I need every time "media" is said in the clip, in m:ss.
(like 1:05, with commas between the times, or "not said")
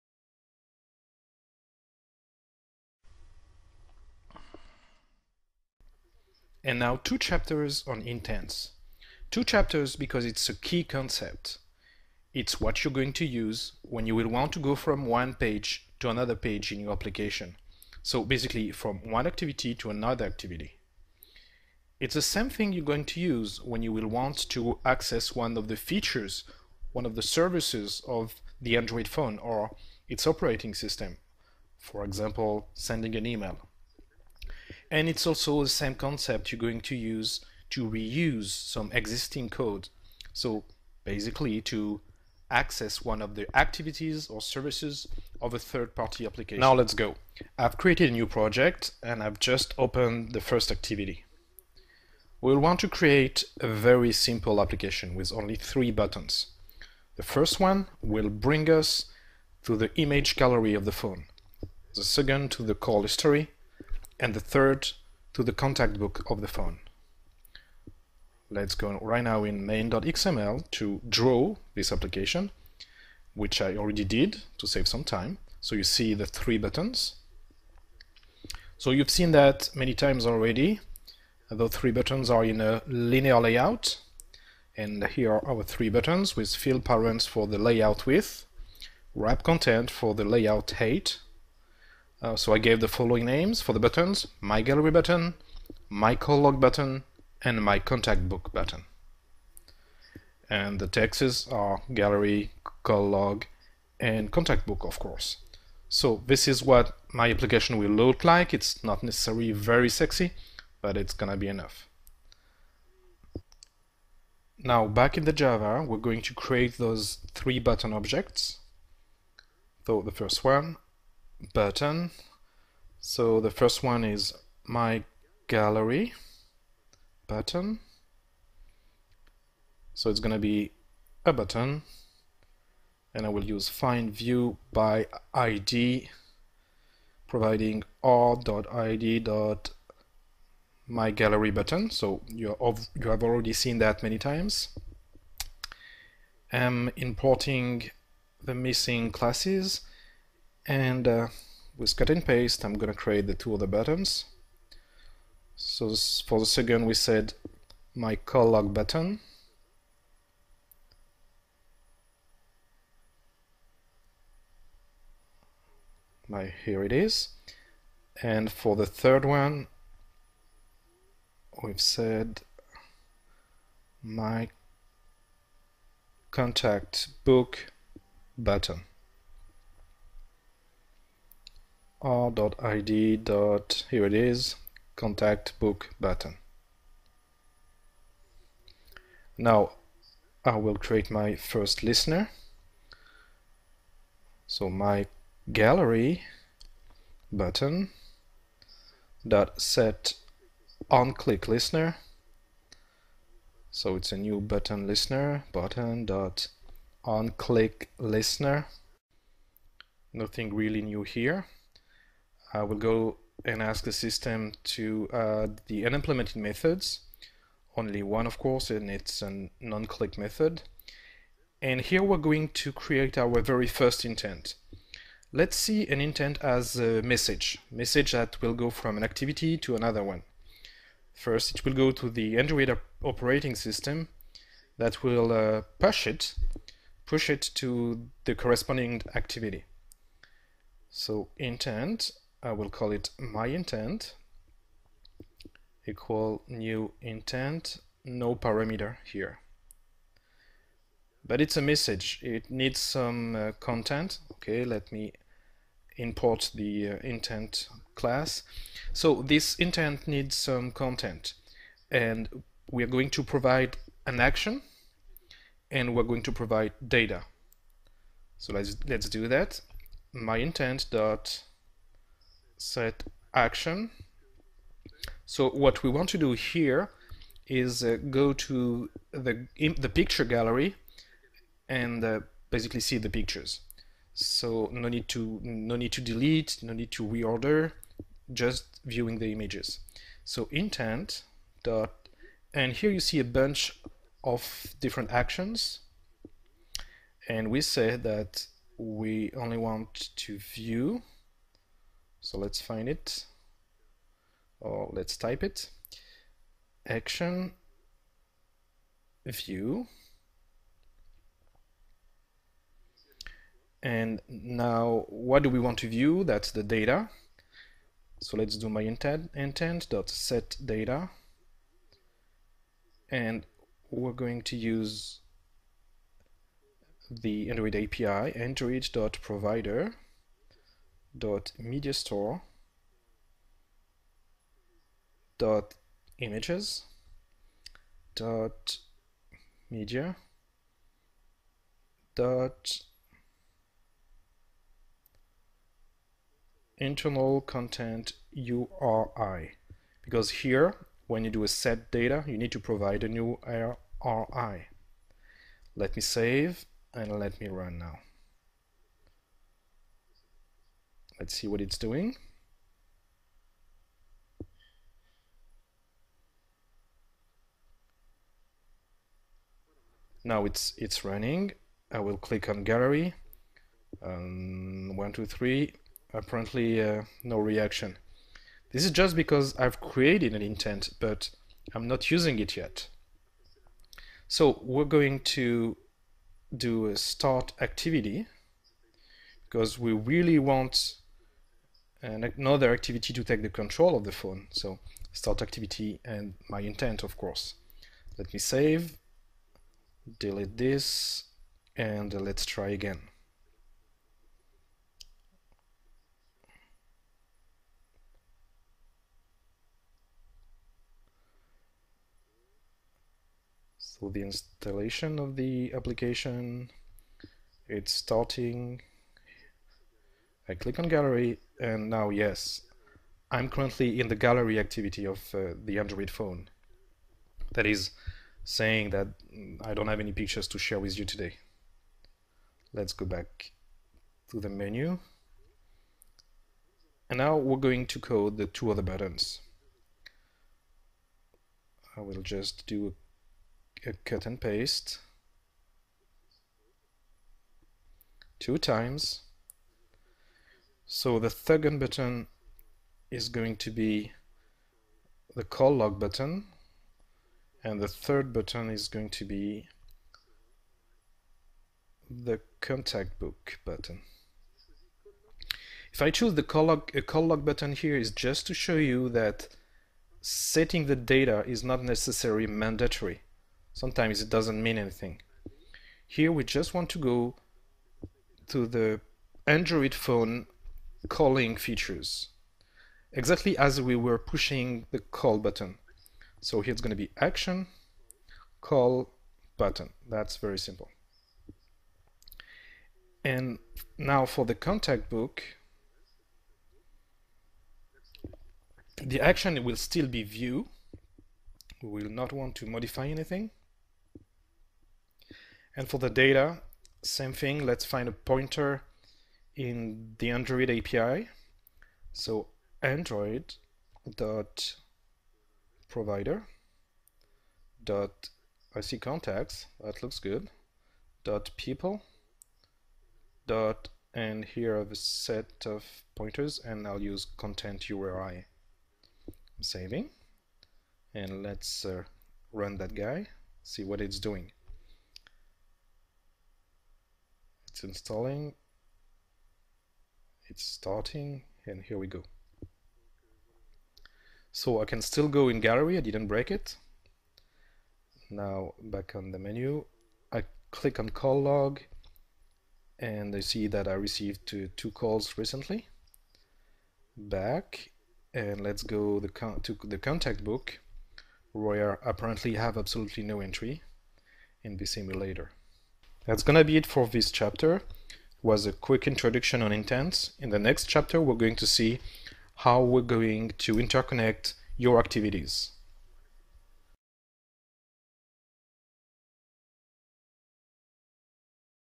5:31, 5:39.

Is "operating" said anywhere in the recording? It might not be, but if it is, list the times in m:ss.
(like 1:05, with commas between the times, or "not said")
0:30, 3:53.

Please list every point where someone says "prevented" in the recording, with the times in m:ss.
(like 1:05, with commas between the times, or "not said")
not said.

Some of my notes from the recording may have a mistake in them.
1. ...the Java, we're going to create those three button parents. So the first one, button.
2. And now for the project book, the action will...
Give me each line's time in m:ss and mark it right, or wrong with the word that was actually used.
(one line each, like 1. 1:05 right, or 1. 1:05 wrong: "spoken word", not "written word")
1. 1:55 wrong: "objects", not "parents"
2. 8:13 wrong: "contact", not "project".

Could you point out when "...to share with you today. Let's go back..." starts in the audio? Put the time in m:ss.
7:10.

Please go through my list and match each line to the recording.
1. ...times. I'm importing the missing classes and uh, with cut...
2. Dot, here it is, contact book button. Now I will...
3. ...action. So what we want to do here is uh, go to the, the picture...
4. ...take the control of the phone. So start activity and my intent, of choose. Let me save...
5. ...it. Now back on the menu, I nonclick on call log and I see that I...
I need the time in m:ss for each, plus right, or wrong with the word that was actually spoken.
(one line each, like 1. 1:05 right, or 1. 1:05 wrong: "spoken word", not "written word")
1. 2:24 right
2. 3:03 right
3. 4:33 right
4. 6:33 wrong: "course", not "choose"
5. 9:06 wrong: "click", not "nonclick".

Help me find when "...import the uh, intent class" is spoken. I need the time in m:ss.
4:15.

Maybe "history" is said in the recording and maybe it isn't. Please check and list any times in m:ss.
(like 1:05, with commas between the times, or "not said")
1:03.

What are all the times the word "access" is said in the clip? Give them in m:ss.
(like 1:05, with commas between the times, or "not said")
0:24, 0:42.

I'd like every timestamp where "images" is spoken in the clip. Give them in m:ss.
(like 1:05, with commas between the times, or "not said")
0:59, 4:49, 5:36.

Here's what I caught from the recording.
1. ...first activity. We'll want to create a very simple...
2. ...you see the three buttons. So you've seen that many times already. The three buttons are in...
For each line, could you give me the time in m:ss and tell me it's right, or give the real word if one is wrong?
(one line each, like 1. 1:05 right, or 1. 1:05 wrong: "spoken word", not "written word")
1. 0:50 right
2. 1:15 right.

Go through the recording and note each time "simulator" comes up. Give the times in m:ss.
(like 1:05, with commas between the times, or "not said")
9:24.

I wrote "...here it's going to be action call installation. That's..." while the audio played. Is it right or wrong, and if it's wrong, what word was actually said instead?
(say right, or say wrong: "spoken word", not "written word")
wrong: "button", not "installation".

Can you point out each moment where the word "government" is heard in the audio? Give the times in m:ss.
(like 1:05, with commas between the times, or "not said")
not said.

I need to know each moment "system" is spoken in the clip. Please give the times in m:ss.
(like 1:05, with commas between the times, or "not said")
0:30, 3:33, 3:53.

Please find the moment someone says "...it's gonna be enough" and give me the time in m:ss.
1:50.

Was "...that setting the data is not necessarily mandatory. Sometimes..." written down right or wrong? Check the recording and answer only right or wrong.
right.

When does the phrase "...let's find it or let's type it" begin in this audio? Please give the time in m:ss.
5:02.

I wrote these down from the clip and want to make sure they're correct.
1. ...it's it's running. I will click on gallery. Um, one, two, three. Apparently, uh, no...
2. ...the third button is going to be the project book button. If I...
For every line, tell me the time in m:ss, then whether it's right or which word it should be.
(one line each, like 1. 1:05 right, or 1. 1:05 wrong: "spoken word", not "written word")
1. 6:10 right
2. 7:37 wrong: "contact", not "project".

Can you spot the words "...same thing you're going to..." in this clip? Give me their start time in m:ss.
0:22.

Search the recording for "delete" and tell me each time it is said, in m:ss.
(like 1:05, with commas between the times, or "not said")
4:46, 6:40.